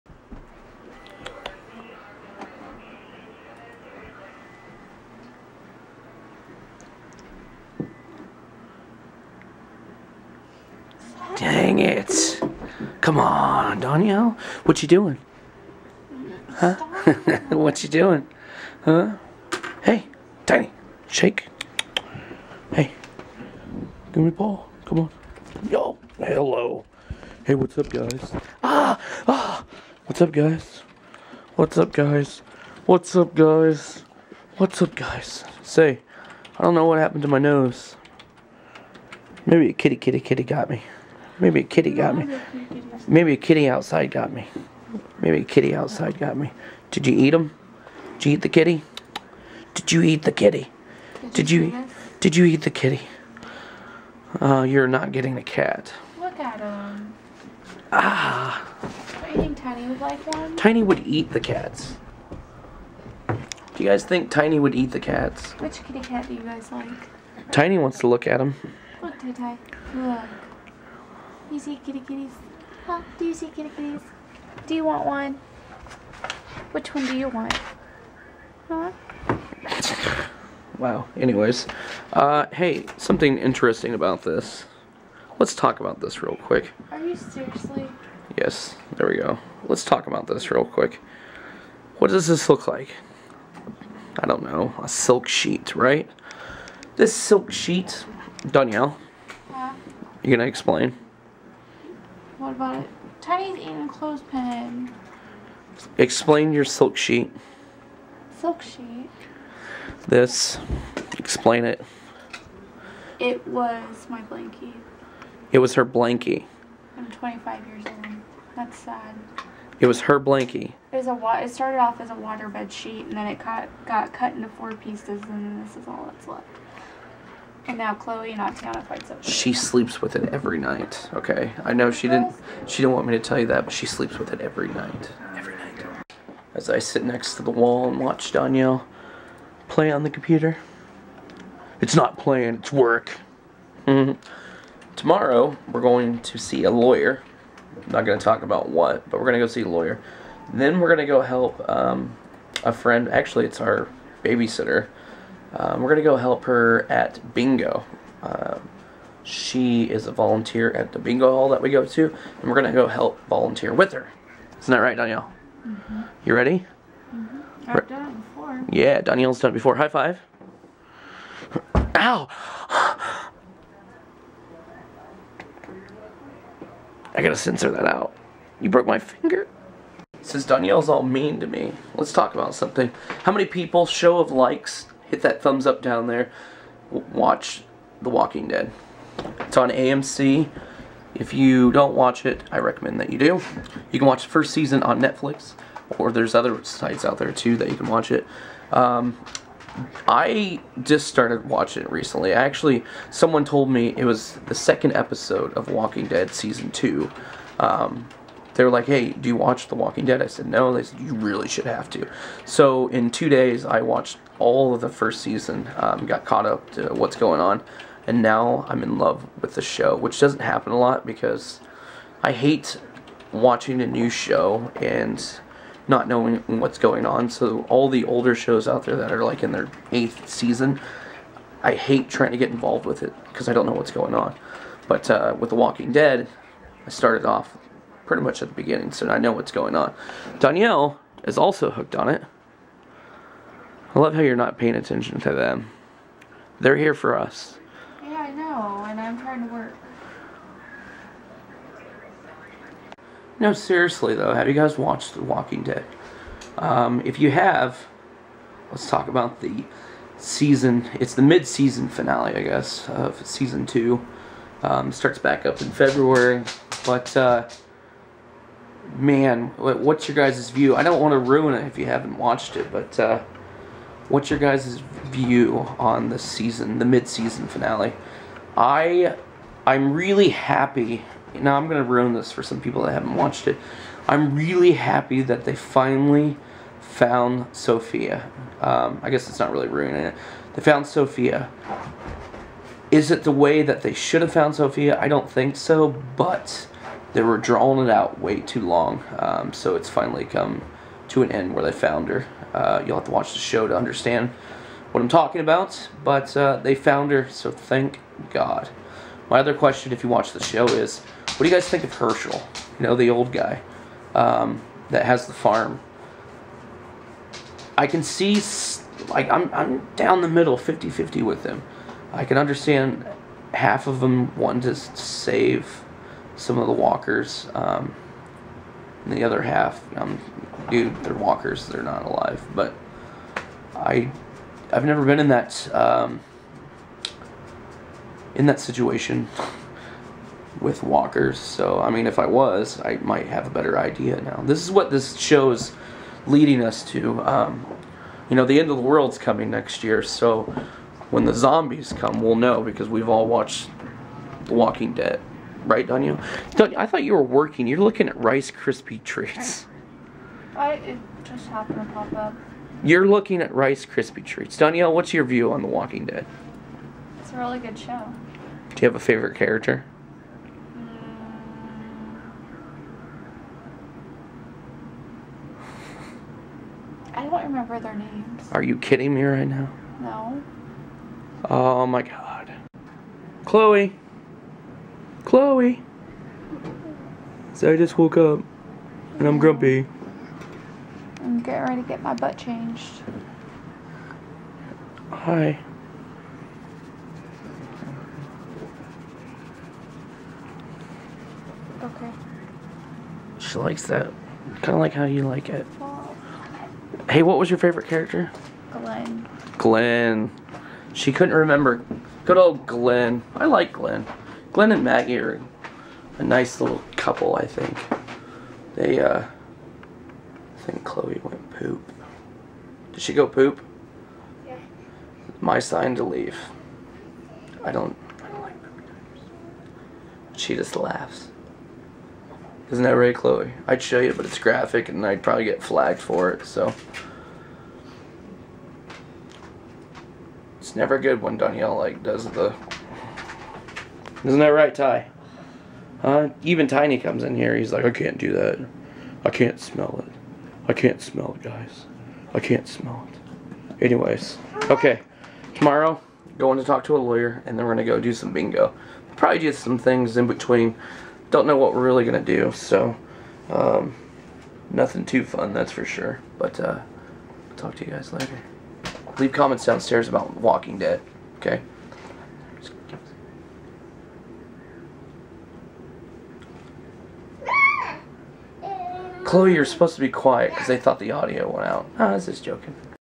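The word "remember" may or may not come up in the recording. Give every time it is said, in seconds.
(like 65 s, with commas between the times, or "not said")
377 s, 411 s.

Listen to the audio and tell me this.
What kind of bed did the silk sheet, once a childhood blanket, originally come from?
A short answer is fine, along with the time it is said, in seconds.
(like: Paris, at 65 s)
Waterbed, at 122 s.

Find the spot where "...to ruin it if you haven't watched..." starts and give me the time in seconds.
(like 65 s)
271 s.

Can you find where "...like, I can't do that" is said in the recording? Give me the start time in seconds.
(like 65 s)
447 s.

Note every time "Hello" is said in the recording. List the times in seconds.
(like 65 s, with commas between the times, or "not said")
26 s.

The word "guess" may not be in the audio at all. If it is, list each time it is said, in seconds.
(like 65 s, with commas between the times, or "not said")
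262 s, 289 s.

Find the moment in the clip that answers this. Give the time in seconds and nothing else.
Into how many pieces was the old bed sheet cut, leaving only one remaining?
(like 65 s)
124 s.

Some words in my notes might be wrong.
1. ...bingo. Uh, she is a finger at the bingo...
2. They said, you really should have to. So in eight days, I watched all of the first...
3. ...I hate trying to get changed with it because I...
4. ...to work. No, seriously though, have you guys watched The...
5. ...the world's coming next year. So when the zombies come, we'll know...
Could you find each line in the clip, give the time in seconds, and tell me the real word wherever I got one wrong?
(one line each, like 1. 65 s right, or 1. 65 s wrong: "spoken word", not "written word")
1. 157 s wrong: "volunteer", not "finger"
2. 210 s wrong: "two", not "eight"
3. 231 s wrong: "involved", not "changed"
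4. 249 s right
5. 348 s right.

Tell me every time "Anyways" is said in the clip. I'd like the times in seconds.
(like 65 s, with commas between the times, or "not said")
81 s, 453 s.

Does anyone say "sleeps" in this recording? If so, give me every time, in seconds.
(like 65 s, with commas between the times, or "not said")
129 s, 133 s.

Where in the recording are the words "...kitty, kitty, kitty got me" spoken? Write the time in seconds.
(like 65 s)
39 s.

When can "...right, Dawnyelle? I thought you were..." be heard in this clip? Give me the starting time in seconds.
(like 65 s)
355 s.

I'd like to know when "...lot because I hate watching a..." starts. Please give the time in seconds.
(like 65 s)
220 s.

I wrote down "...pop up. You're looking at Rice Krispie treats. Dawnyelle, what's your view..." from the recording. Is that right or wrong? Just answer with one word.
right.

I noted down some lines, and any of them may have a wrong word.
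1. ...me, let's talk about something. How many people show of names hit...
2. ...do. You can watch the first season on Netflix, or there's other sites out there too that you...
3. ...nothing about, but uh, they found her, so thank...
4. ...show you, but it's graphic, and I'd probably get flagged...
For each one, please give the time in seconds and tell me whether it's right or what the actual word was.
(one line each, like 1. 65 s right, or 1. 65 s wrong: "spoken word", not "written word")
1. 181 s wrong: "likes", not "names"
2. 193 s right
3. 305 s wrong: "talking", not "nothing"
4. 433 s right.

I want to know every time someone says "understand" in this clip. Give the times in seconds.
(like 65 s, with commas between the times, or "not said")
303 s, 322 s.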